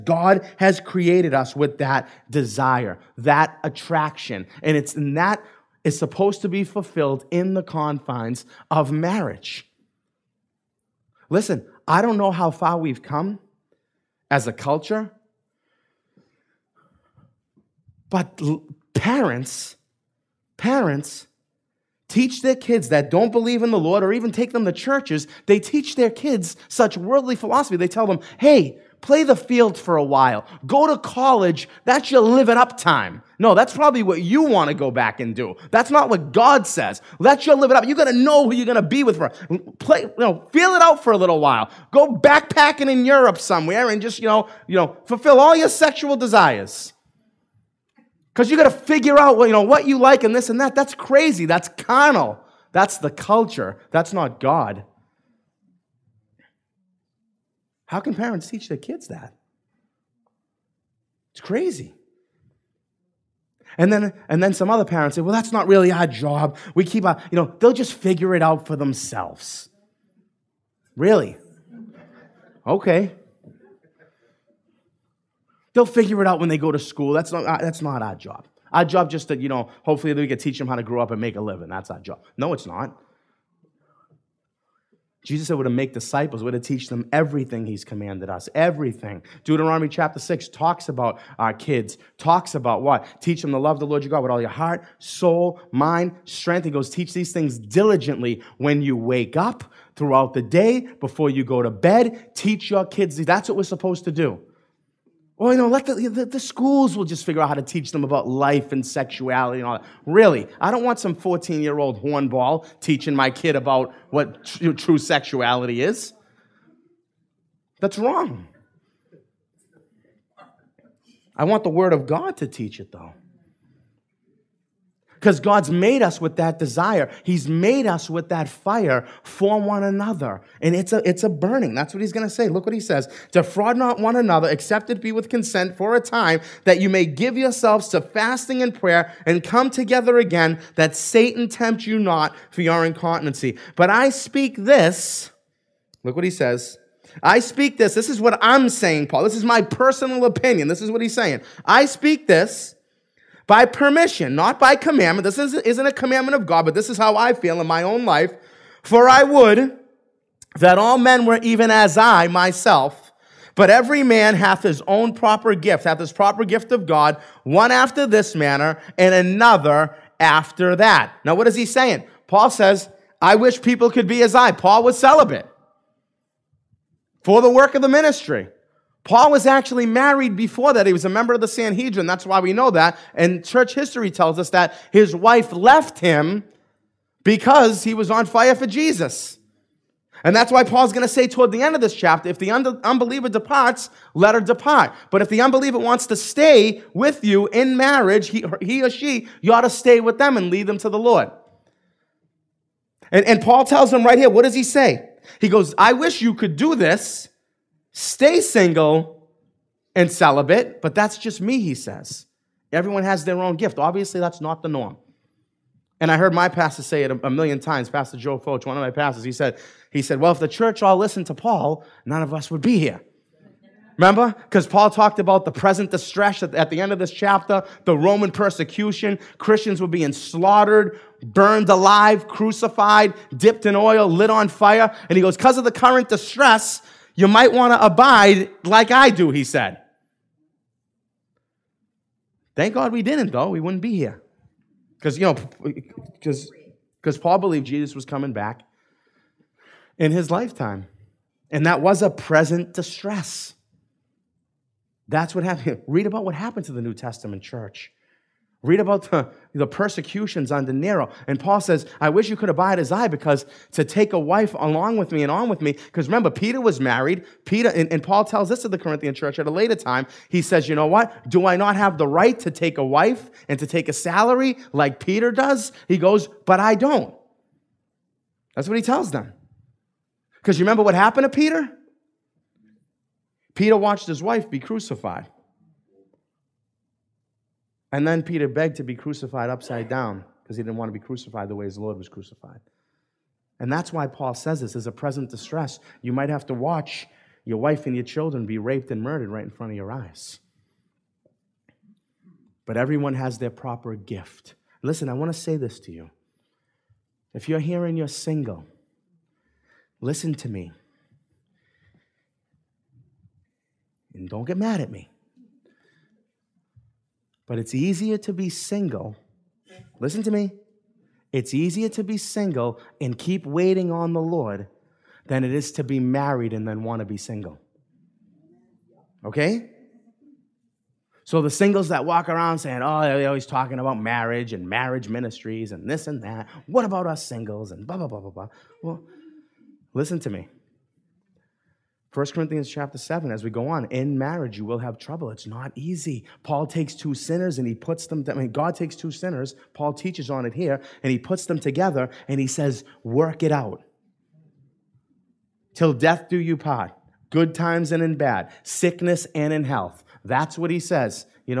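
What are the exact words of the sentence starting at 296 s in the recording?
You might have to watch your wife and your children be raped and murdered right in front of your eyes.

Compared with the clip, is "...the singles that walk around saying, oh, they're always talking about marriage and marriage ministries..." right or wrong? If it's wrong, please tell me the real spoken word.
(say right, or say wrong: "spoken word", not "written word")
right.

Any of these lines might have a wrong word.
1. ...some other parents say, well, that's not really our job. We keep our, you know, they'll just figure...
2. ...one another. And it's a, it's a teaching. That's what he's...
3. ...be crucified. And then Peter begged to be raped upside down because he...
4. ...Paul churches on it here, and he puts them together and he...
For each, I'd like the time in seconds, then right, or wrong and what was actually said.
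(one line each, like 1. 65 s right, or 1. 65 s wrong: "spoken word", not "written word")
1. 64 s right
2. 129 s wrong: "burning", not "teaching"
3. 284 s wrong: "crucified", not "raped"
4. 349 s wrong: "teaches", not "churches".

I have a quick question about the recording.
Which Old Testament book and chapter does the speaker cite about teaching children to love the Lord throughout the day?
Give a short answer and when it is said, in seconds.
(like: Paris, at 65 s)
Deuteronomy chapter 6, at 89 s.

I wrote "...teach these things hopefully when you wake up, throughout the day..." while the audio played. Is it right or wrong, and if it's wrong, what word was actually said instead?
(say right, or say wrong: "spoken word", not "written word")
wrong: "diligently", not "hopefully".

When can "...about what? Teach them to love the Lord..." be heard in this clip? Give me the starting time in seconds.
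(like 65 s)
92 s.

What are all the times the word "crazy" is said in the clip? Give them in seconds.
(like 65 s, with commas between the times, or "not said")
50 s, 61 s.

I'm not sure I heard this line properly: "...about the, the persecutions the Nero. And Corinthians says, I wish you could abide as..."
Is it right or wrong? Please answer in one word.
wrong.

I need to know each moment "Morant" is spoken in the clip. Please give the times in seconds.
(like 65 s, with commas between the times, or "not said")
not said.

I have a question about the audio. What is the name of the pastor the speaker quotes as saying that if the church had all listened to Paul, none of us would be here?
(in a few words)
Joe Focht.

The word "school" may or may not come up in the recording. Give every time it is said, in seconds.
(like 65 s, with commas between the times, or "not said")
76 s, 106 s.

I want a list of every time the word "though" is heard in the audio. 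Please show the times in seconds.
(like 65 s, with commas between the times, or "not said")
122 s, 243 s.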